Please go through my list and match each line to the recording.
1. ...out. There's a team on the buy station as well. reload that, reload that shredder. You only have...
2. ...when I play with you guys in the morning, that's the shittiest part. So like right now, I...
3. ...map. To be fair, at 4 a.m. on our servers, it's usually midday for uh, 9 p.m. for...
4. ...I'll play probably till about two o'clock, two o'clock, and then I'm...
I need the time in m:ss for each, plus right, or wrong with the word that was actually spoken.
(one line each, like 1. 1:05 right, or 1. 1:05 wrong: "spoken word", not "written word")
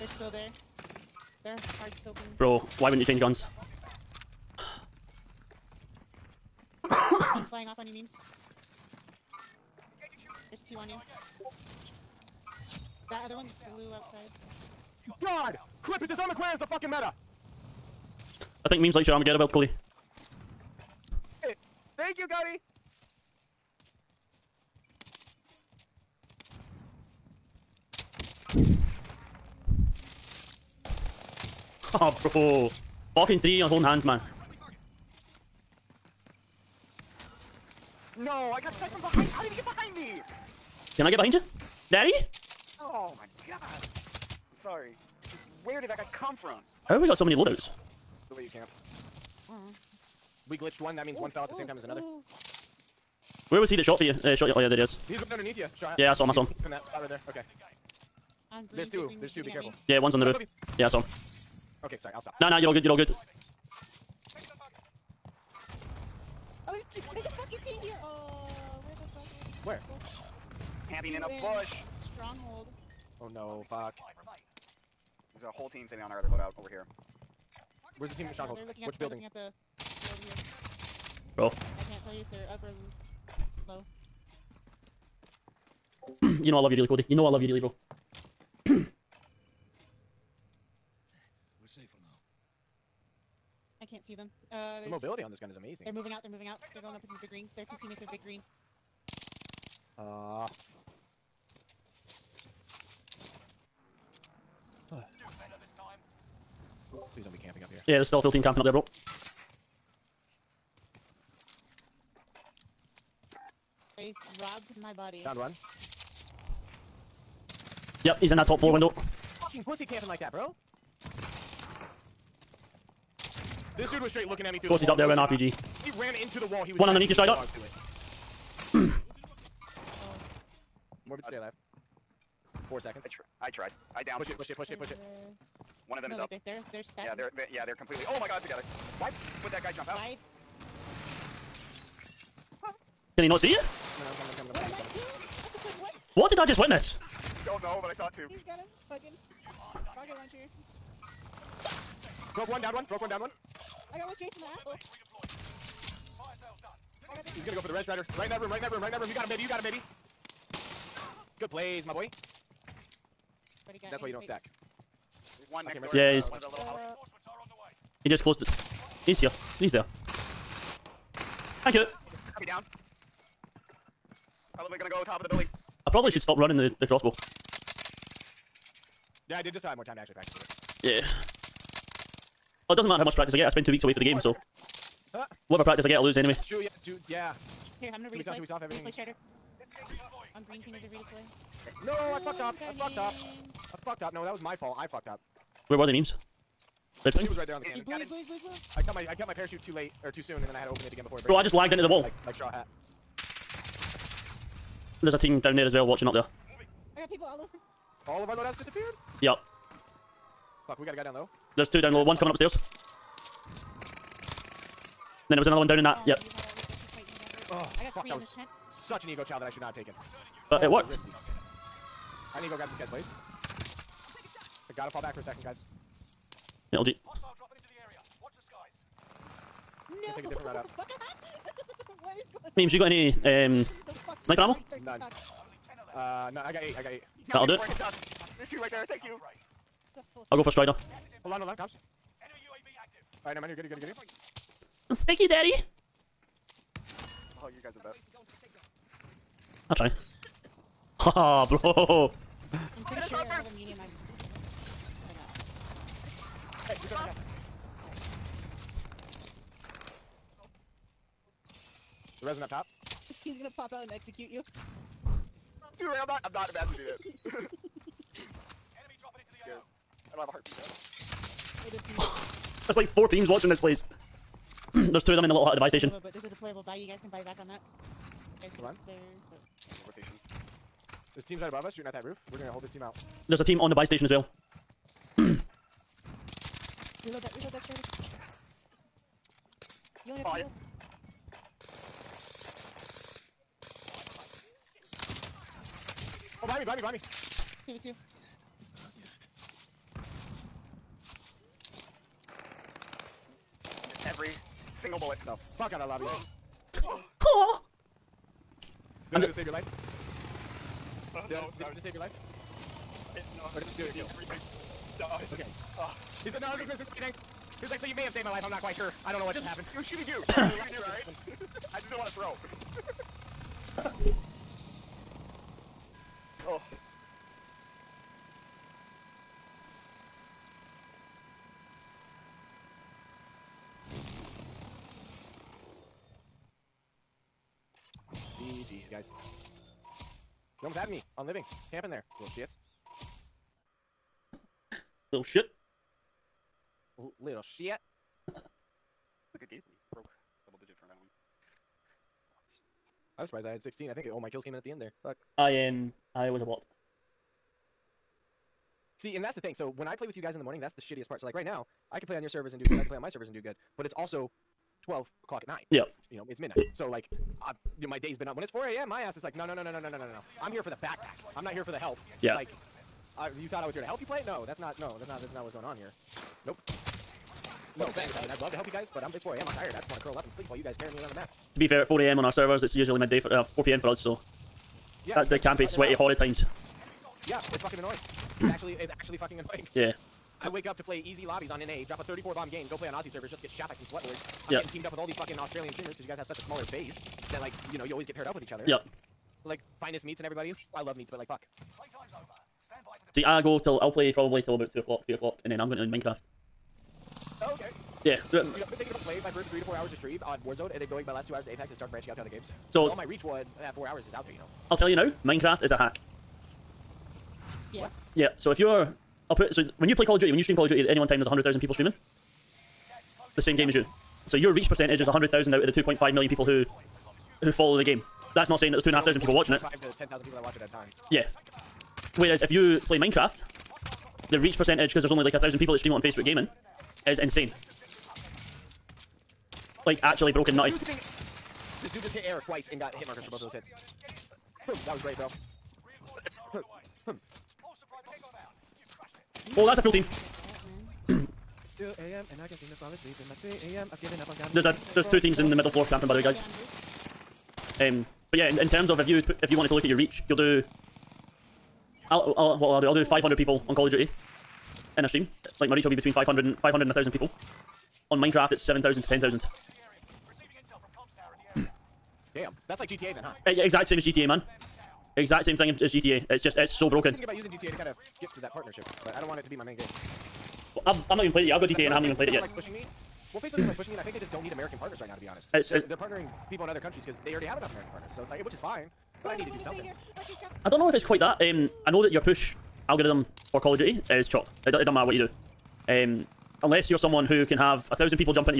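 1. 4:42 right
2. 5:59 right
3. 6:21 wrong: "4", not "9"
4. 6:43 wrong: "three", not "two".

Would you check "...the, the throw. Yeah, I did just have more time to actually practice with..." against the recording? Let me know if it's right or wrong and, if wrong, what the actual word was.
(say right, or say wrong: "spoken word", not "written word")
wrong: "crossbow", not "throw".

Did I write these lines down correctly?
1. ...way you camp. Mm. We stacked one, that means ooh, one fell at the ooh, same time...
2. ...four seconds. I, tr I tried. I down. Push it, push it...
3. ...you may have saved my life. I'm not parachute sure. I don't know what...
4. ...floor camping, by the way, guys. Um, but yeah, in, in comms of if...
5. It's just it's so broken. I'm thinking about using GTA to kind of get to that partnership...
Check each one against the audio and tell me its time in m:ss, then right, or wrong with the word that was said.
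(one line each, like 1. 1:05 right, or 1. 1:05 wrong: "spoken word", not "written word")
1. 0:48 wrong: "glitched", not "stacked"
2. 2:12 right
3. 5:17 wrong: "quite", not "parachute"
4. 7:35 wrong: "terms", not "comms"
5. 7:56 right.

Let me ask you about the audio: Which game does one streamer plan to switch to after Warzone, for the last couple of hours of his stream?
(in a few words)
Apex.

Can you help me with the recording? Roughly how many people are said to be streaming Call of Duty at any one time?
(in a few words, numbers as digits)
100,000.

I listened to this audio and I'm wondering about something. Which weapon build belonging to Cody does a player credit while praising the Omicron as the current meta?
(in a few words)
Armaguerra build.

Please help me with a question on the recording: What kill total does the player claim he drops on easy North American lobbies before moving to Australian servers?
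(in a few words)
34.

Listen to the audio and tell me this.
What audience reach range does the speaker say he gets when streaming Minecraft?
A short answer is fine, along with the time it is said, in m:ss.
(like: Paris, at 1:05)
7,000 to 10,000, at 7:48.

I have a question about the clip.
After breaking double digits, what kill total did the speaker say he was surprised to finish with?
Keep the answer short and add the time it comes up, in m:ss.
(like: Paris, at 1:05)
16, at 5:53.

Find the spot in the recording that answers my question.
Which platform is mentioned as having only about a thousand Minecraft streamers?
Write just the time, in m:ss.
7:15.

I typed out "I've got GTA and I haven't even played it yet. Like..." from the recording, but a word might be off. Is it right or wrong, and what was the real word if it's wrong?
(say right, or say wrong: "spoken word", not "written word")
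right.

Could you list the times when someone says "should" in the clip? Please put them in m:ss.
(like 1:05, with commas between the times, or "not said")
2:56, 3:39.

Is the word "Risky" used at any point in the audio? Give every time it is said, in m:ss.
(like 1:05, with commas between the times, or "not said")
3:40.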